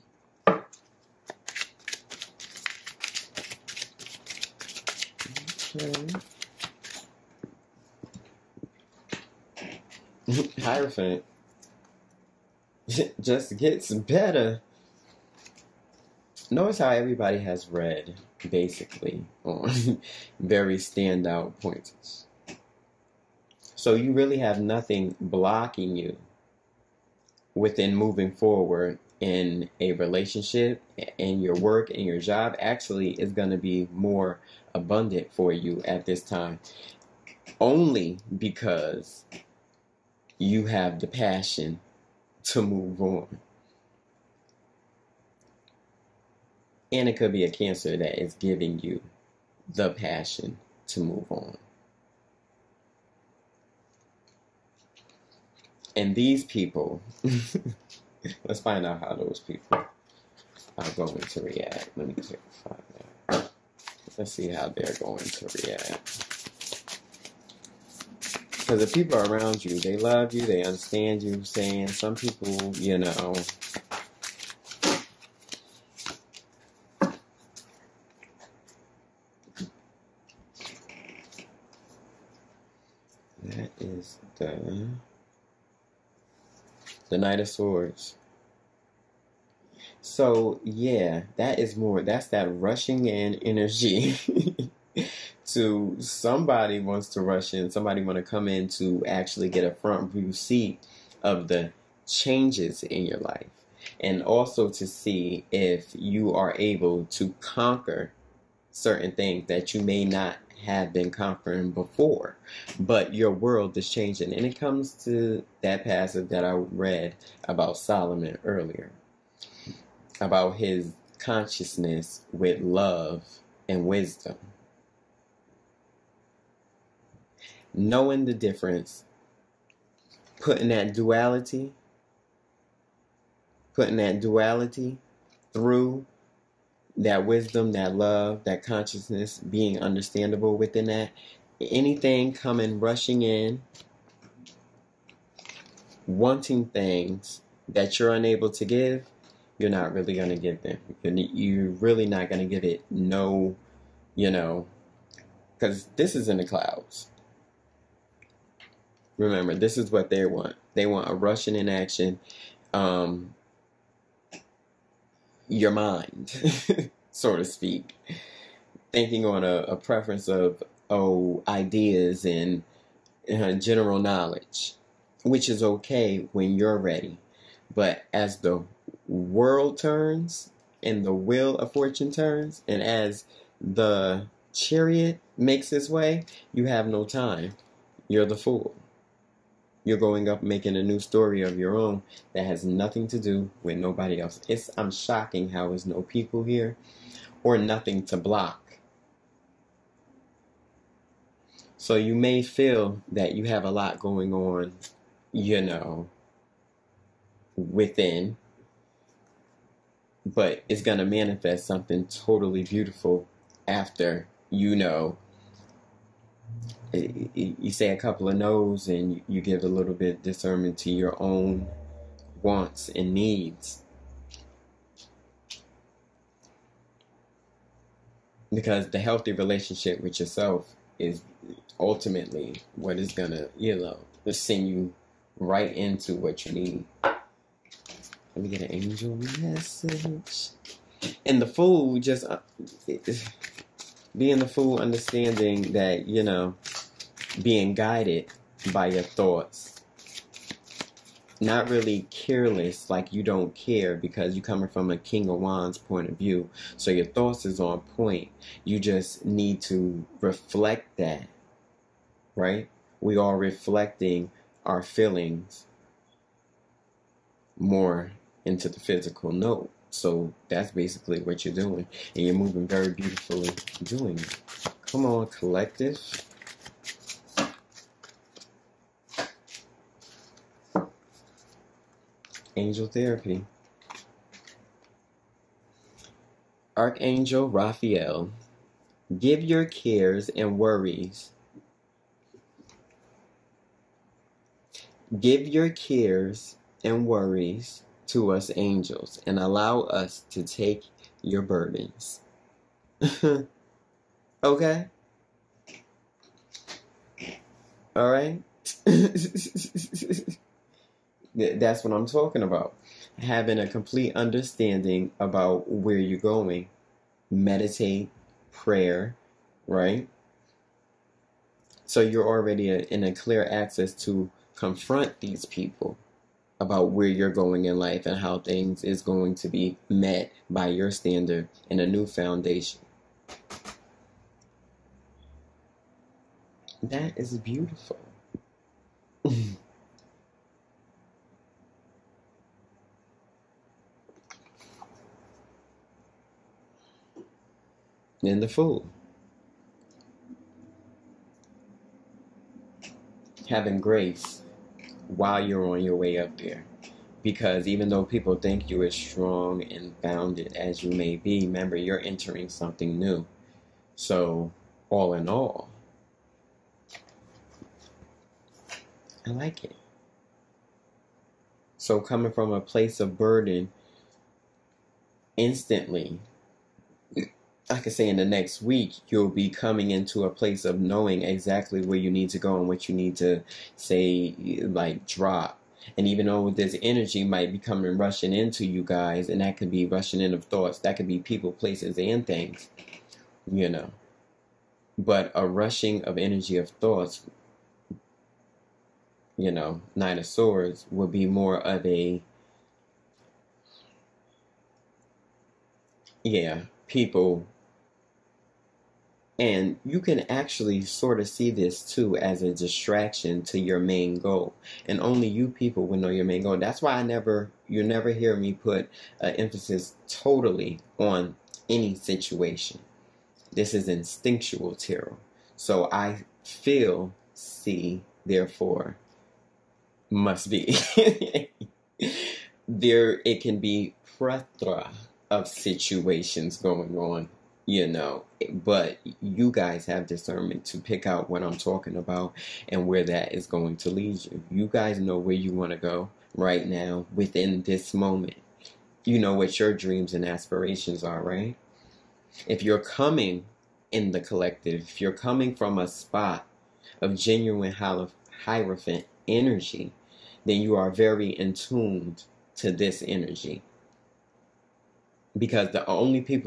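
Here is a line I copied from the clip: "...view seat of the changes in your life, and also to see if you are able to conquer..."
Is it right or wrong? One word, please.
right.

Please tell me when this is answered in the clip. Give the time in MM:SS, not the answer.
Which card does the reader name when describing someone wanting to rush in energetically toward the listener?
01:27.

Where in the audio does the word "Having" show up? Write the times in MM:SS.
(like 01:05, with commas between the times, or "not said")
05:13, 05:53.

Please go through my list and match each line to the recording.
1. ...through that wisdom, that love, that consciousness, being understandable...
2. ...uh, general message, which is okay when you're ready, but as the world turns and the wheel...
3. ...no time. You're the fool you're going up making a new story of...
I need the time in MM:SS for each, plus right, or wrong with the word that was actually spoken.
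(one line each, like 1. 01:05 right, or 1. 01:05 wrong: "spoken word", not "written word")
1. 02:15 right
2. 02:53 wrong: "knowledge", not "message"
3. 03:06 right.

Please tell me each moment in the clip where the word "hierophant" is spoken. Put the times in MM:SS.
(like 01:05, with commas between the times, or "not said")
00:10, 07:38.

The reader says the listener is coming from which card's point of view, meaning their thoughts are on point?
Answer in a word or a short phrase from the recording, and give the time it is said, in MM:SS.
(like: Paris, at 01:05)
King of Wands, at 04:14.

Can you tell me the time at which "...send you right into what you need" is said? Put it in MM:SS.
03:54.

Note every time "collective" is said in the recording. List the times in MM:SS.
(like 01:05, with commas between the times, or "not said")
04:35, 07:34.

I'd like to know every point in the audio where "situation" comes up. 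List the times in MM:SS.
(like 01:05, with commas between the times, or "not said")
07:01, 07:15.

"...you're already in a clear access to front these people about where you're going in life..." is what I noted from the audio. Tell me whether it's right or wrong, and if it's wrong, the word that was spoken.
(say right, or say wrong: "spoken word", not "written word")
wrong: "confront", not "front".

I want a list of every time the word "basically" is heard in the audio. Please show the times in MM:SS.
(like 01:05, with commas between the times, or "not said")
00:18, 04:30.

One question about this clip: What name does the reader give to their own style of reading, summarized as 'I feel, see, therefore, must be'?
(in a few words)
Instinctual tarot.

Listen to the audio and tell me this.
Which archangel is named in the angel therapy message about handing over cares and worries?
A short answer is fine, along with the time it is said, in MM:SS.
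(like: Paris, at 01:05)
Raphael, at 04:47.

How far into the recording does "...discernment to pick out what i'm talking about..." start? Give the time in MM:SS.
07:20.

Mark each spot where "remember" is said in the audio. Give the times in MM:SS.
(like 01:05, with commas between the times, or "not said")
02:39, 06:01.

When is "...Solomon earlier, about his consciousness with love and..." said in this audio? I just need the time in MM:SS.
01:57.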